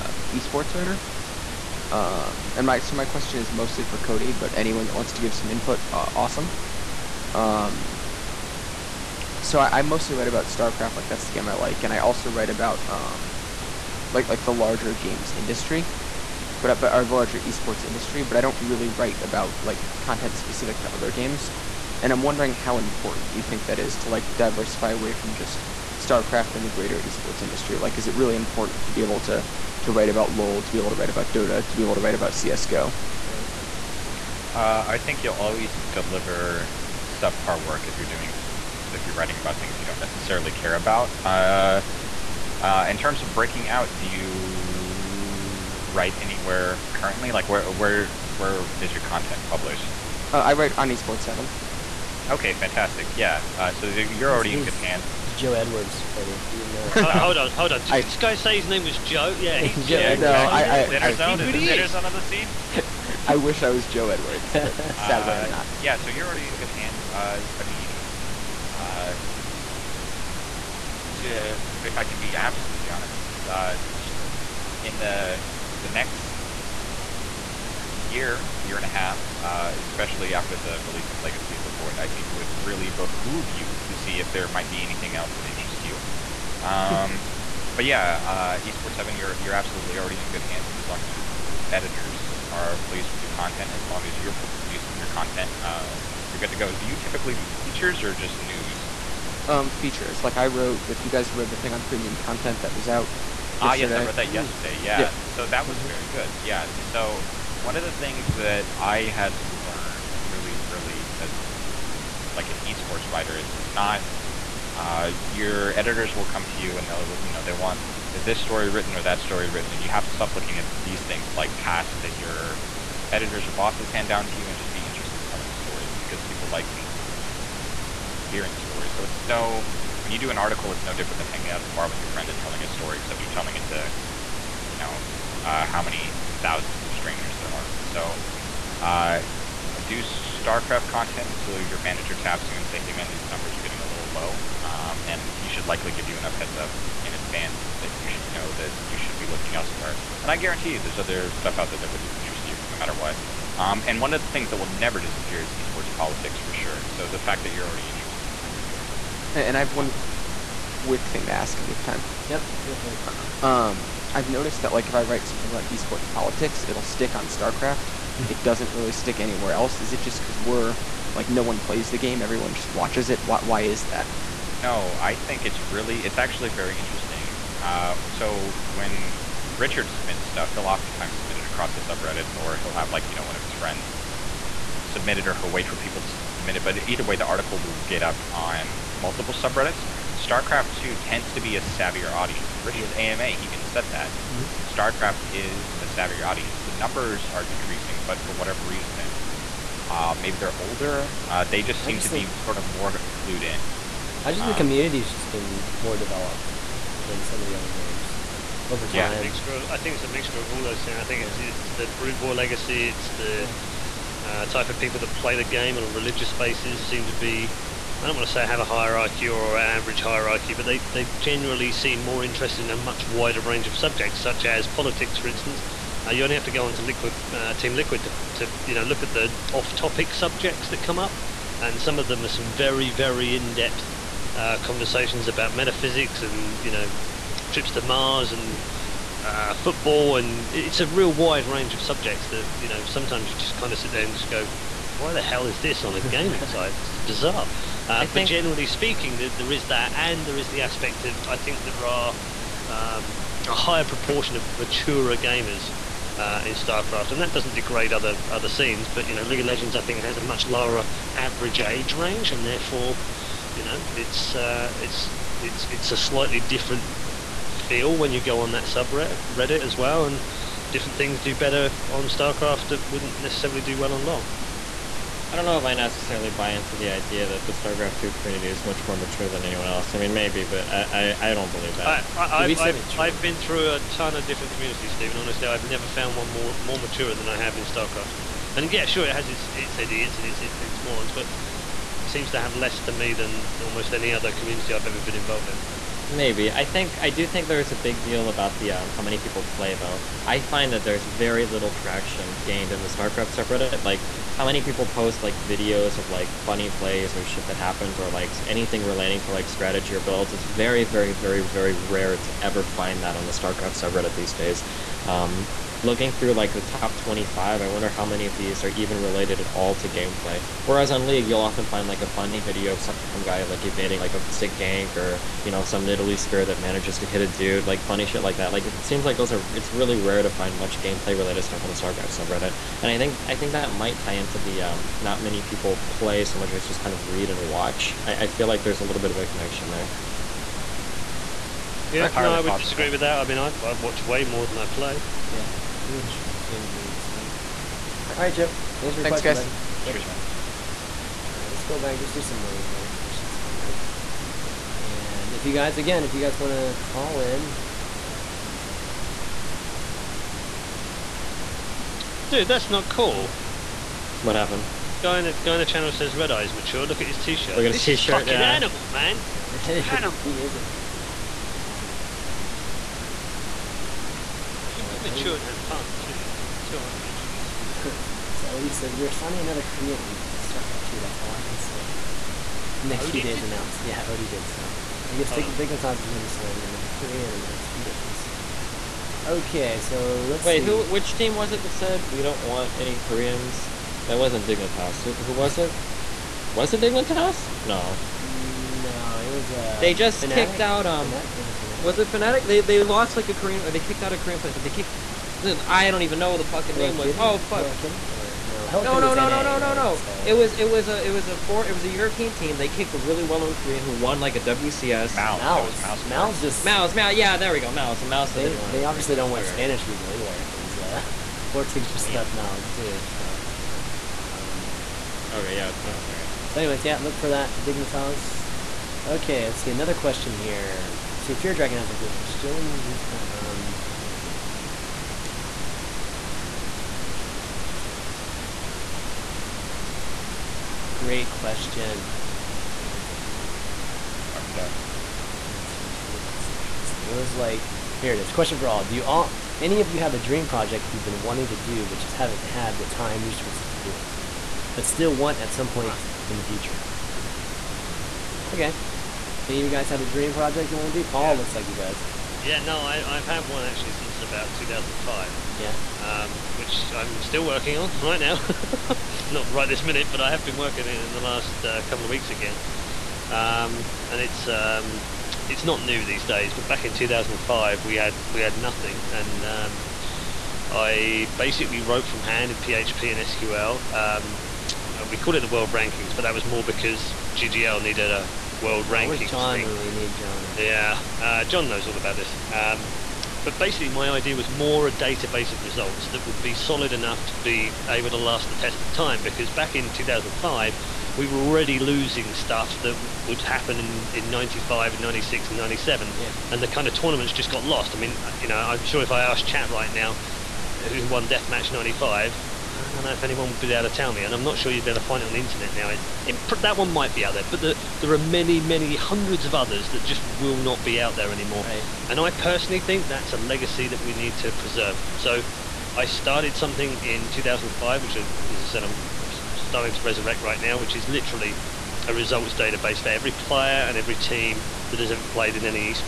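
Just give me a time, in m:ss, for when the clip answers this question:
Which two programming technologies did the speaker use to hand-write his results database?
8:02.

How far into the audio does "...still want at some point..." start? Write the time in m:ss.
7:34.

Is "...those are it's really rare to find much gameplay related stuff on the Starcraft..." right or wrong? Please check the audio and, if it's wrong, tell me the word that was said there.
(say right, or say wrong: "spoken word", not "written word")
right.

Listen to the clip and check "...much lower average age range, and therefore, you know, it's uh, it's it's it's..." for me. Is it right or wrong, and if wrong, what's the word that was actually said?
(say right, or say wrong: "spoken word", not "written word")
right.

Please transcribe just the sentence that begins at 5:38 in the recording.
I, I feel like there's a little bit of a connection there.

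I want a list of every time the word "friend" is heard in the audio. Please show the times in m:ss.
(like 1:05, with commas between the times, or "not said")
2:12, 3:03.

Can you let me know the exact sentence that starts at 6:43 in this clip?
Or they kicked out a Korean player.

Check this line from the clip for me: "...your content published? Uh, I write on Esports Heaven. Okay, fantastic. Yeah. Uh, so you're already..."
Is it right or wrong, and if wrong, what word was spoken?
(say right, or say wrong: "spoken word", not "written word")
right.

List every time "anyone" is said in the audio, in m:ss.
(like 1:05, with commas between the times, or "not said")
0:04, 4:39, 8:33.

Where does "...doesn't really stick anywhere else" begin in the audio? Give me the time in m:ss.
2:48.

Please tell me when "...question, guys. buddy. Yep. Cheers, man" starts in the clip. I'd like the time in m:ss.
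5:49.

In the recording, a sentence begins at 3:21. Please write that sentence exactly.
Uh, they just seem just to think, be sort of more clued in.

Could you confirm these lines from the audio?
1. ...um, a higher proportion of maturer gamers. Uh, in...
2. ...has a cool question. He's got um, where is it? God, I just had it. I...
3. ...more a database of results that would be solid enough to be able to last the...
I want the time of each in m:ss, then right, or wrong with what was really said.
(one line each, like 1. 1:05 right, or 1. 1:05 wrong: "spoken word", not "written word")
1. 4:12 right
2. 7:11 right
3. 8:14 right.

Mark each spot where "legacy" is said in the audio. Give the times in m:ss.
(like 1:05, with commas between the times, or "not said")
1:21, 3:32, 8:43.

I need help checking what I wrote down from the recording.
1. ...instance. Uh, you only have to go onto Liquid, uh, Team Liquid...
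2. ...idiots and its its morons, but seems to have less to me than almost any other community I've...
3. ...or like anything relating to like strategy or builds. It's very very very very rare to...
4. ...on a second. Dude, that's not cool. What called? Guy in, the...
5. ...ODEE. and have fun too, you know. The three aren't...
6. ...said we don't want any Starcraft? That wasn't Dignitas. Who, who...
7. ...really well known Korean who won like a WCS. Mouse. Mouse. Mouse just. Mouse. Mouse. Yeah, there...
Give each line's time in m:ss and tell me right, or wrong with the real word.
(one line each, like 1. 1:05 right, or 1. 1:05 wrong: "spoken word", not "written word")
1. 3:45 right
2. 4:49 right
3. 5:07 right
4. 5:58 wrong: "happened", not "called"
5. 6:15 wrong: "two", not "three"
6. 6:31 wrong: "Koreans", not "Starcraft"
7. 6:52 right.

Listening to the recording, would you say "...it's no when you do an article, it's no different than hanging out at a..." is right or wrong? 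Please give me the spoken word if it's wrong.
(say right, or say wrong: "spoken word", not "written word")
right.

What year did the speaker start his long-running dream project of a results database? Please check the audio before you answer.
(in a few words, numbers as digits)
2005.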